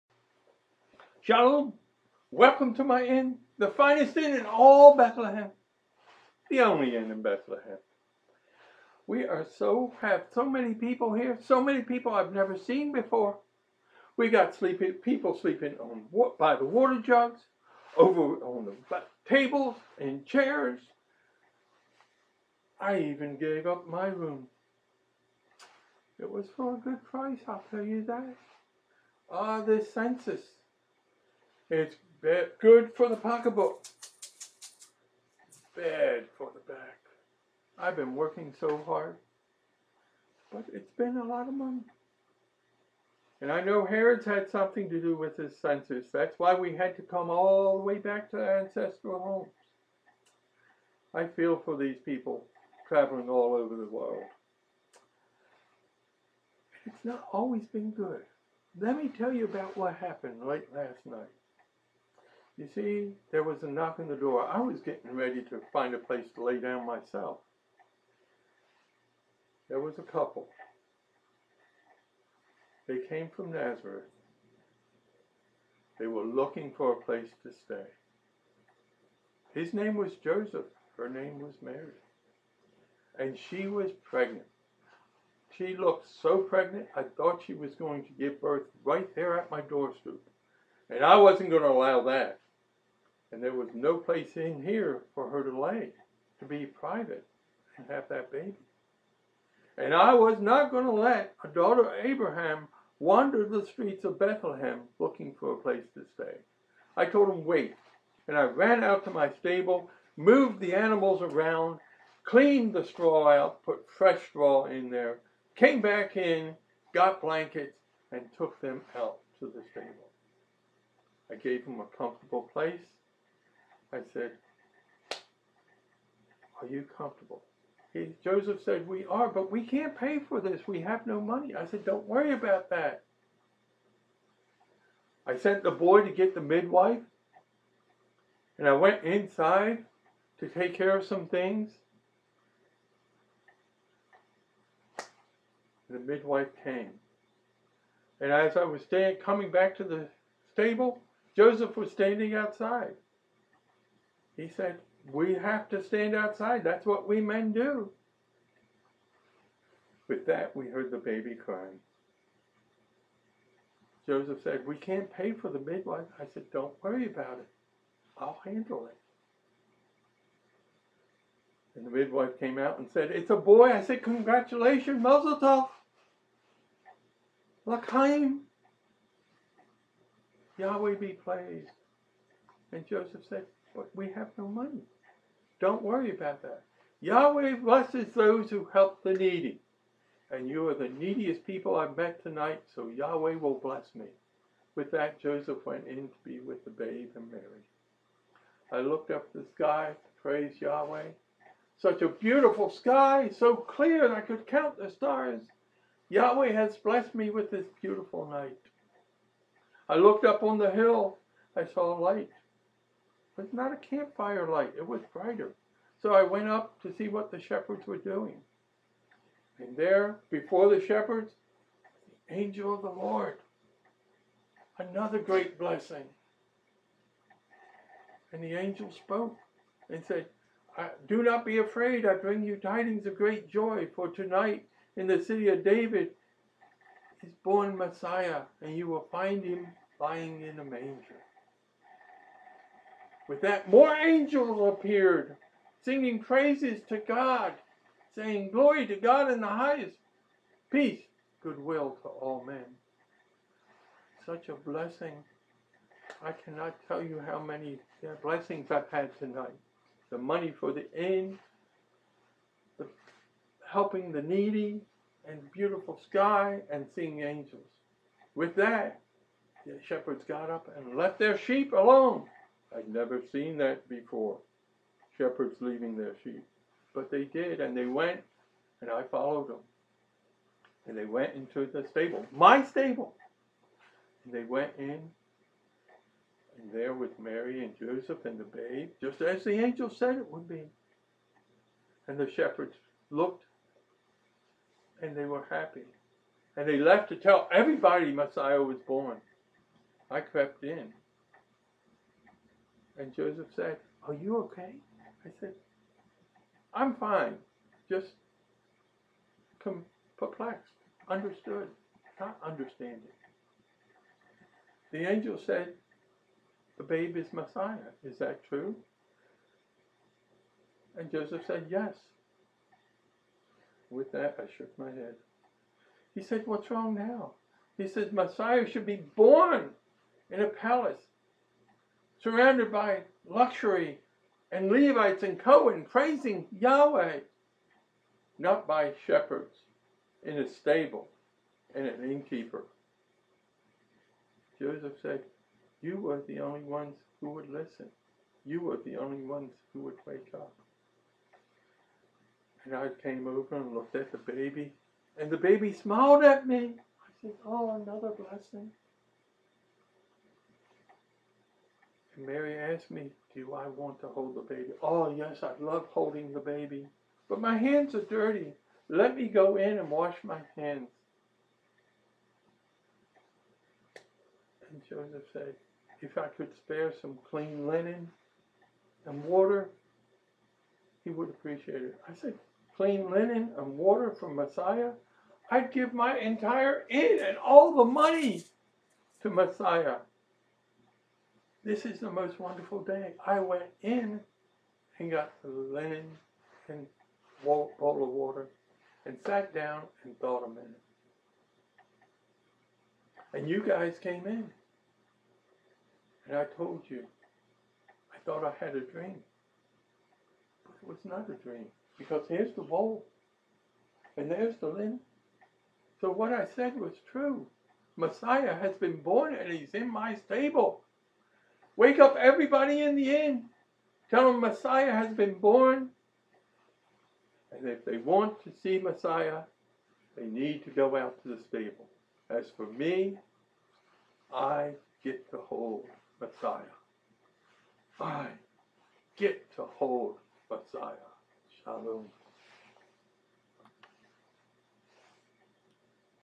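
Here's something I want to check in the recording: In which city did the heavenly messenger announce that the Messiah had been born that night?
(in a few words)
City of David.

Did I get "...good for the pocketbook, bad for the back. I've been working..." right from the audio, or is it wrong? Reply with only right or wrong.
right.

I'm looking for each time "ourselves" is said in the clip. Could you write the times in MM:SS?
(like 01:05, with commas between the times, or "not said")
not said.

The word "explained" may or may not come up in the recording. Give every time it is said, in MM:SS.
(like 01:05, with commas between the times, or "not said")
not said.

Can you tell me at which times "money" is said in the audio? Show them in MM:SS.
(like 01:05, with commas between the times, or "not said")
00:41, 02:11, 03:04, 04:20, 06:27.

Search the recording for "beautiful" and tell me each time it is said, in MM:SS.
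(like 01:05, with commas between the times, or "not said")
03:22, 03:27, 04:25.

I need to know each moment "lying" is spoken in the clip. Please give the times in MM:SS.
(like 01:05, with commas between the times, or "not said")
03:59.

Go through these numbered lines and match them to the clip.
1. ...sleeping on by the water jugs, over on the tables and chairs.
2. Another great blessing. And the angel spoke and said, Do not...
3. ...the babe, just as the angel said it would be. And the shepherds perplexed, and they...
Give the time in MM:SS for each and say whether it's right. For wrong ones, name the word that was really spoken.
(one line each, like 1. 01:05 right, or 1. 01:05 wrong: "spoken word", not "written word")
1. 00:15 right
2. 03:44 right
3. 04:48 wrong: "looked", not "perplexed".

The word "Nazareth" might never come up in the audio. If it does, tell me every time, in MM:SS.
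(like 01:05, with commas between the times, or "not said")
01:13.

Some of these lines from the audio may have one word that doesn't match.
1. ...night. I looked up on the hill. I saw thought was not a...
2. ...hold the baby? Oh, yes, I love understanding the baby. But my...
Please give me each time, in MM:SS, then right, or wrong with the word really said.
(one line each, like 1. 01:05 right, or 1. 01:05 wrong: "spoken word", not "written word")
1. 03:28 wrong: "light", not "thought"
2. 06:04 wrong: "holding", not "understanding".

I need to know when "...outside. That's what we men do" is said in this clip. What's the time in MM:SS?
02:36.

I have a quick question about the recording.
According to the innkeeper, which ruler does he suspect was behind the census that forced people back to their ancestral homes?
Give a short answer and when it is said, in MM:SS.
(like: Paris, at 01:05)
Herod, at 00:43.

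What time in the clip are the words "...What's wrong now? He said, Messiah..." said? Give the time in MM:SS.
05:26.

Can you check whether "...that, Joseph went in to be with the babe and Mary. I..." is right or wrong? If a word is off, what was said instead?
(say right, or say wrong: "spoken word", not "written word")
right.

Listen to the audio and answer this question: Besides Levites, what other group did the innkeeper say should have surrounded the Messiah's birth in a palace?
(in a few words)
Cohen.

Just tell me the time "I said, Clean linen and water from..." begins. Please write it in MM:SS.
06:22.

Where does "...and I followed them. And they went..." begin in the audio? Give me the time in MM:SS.
04:38.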